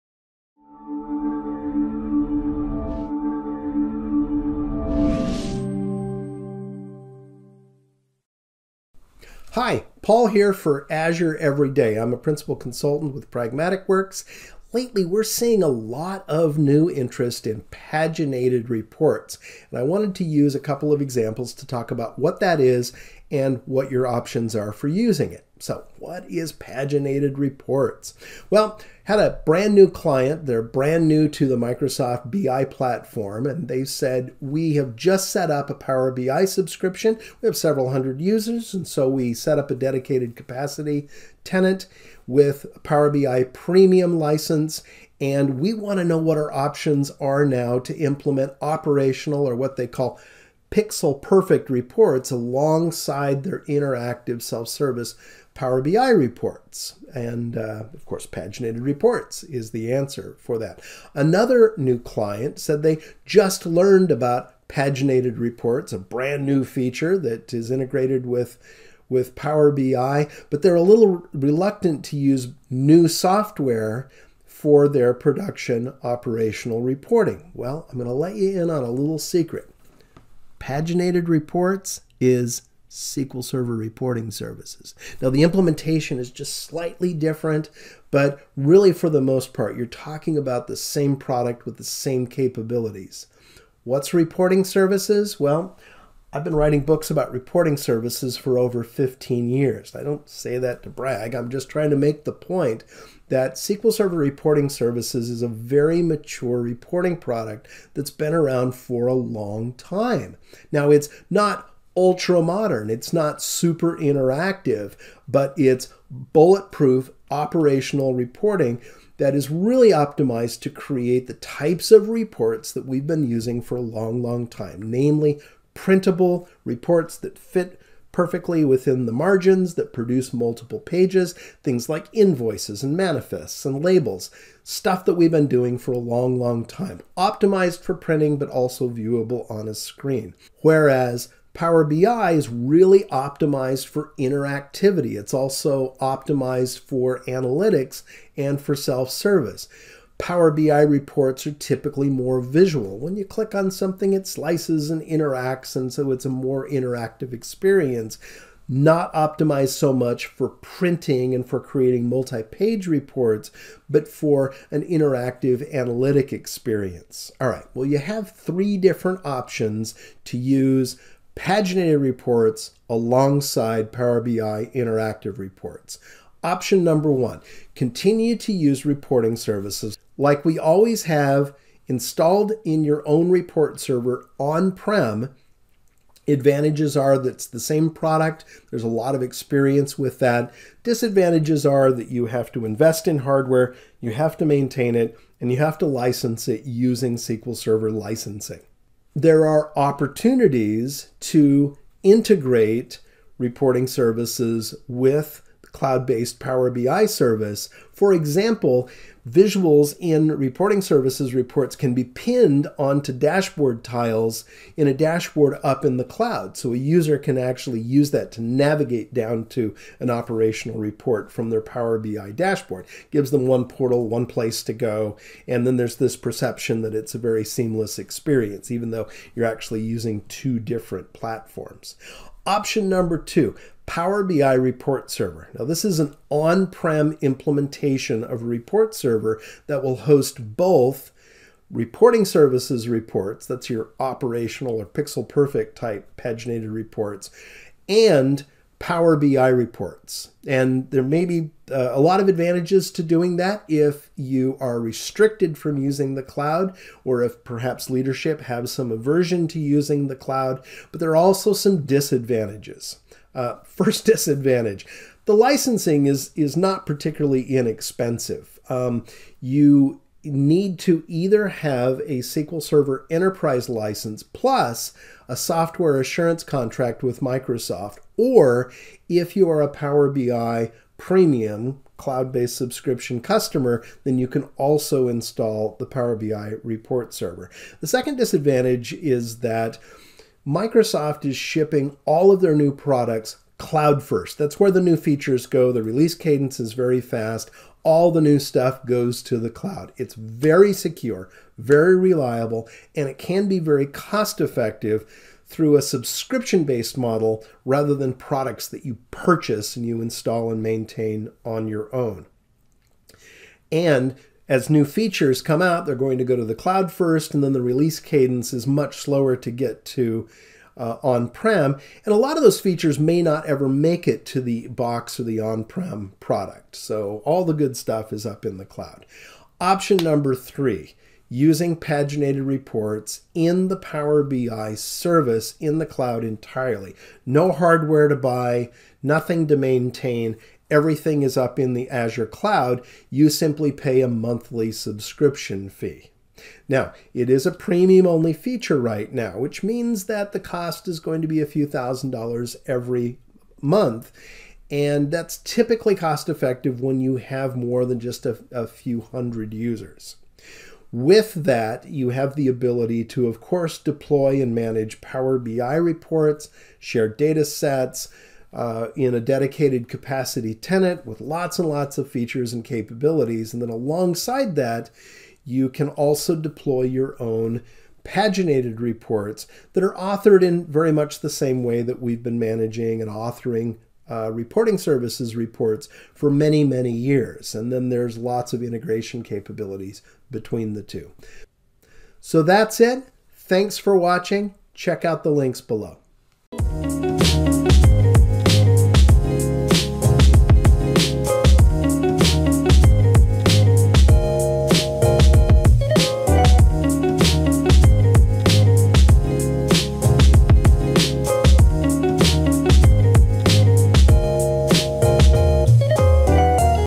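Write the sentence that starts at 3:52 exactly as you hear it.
Option number two, Power BI report server.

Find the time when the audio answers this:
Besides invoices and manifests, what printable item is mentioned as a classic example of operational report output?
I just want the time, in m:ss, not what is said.
2:13.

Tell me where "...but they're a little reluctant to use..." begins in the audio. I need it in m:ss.
1:10.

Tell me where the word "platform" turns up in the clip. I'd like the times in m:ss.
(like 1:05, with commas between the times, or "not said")
0:32, 3:51.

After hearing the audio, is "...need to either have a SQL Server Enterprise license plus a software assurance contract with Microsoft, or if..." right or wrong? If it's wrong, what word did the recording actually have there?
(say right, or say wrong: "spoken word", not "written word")
right.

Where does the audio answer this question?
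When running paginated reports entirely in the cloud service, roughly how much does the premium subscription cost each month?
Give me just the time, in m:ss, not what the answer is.
5:51.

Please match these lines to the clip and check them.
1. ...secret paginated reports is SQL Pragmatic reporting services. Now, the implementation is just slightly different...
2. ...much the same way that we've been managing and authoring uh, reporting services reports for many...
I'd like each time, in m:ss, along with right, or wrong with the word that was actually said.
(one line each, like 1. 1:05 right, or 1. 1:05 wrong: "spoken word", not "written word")
1. 1:19 wrong: "Server", not "Pragmatic"
2. 6:20 right.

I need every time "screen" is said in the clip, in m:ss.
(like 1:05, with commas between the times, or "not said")
2:19.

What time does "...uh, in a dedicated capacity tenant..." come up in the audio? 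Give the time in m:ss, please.
6:08.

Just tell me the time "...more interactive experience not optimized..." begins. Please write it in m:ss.
2:36.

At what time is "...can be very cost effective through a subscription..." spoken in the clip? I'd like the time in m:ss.
5:03.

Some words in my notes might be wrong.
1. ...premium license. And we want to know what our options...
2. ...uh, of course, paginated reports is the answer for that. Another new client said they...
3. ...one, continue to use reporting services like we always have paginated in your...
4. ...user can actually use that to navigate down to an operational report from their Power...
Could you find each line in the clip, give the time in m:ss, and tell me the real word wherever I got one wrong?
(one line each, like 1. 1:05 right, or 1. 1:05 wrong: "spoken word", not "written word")
1. 0:43 right
2. 0:57 right
3. 2:57 wrong: "installed", not "paginated"
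4. 3:36 right.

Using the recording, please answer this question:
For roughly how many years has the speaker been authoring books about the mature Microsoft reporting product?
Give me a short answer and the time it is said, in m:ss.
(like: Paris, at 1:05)
15, at 1:38.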